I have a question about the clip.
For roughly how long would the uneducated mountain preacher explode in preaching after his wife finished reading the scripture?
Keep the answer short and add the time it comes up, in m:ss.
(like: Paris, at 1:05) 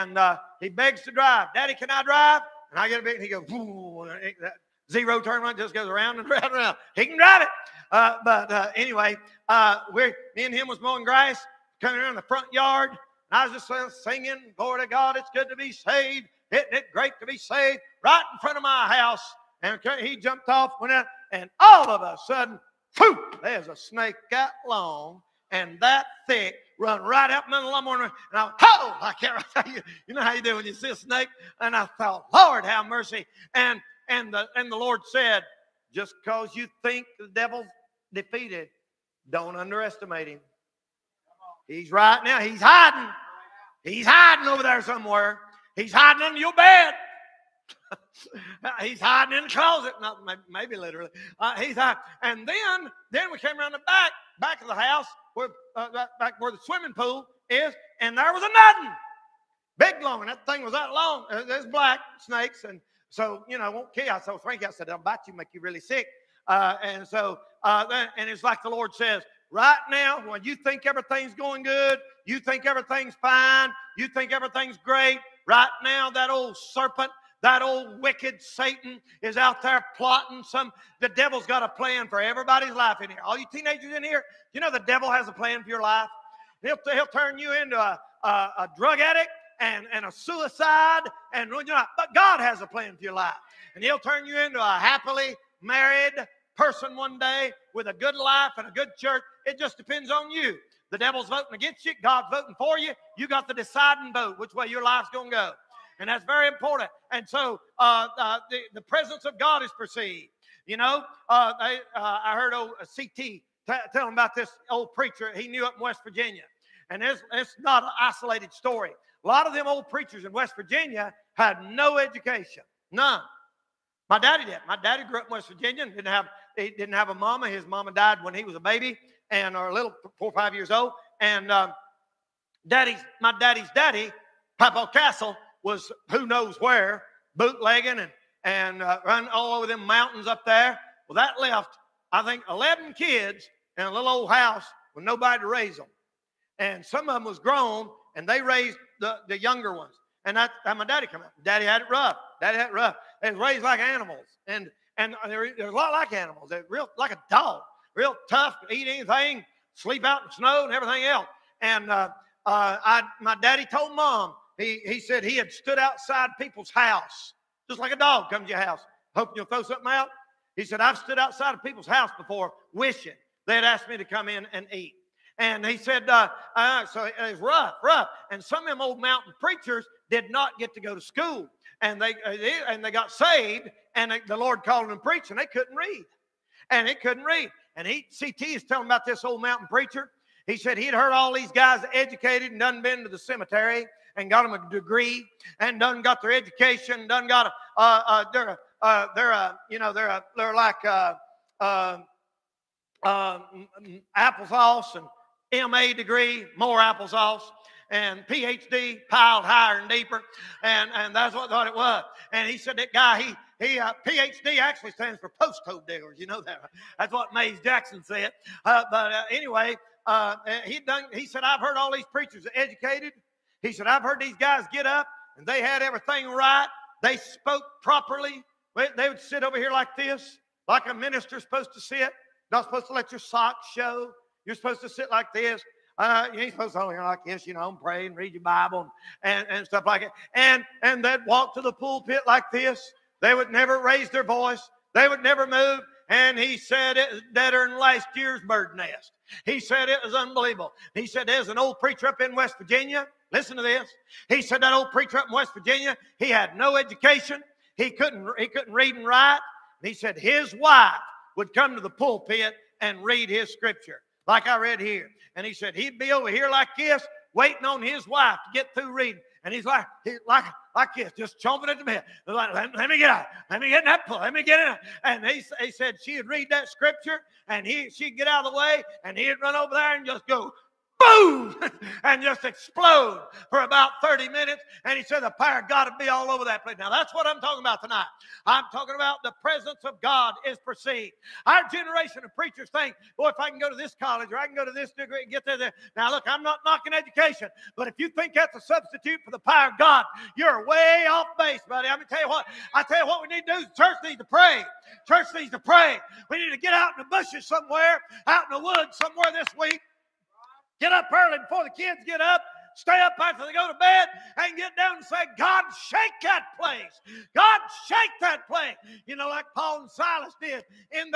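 30 minutes, at 4:44.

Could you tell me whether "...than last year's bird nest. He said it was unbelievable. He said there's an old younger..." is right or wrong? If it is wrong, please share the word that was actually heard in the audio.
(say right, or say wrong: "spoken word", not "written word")
wrong: "preacher", not "younger".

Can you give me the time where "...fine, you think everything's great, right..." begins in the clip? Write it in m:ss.
1:13.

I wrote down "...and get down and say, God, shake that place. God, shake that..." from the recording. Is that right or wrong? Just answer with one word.
right.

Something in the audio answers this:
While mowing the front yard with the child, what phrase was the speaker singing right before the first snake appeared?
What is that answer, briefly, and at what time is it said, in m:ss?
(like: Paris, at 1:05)
Glory to God, at 0:14.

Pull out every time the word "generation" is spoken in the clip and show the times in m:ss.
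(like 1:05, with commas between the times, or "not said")
4:51.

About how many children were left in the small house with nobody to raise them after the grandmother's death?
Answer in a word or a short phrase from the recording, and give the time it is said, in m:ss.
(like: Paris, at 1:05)
11, at 2:22.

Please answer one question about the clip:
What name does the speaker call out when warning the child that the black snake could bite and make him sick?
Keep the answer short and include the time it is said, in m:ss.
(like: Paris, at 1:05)
Frankie, at 1:04.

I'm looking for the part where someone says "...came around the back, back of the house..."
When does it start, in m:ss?
0:53.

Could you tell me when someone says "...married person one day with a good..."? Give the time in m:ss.
1:35.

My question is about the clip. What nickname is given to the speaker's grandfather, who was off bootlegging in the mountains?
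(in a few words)
Papa Castle.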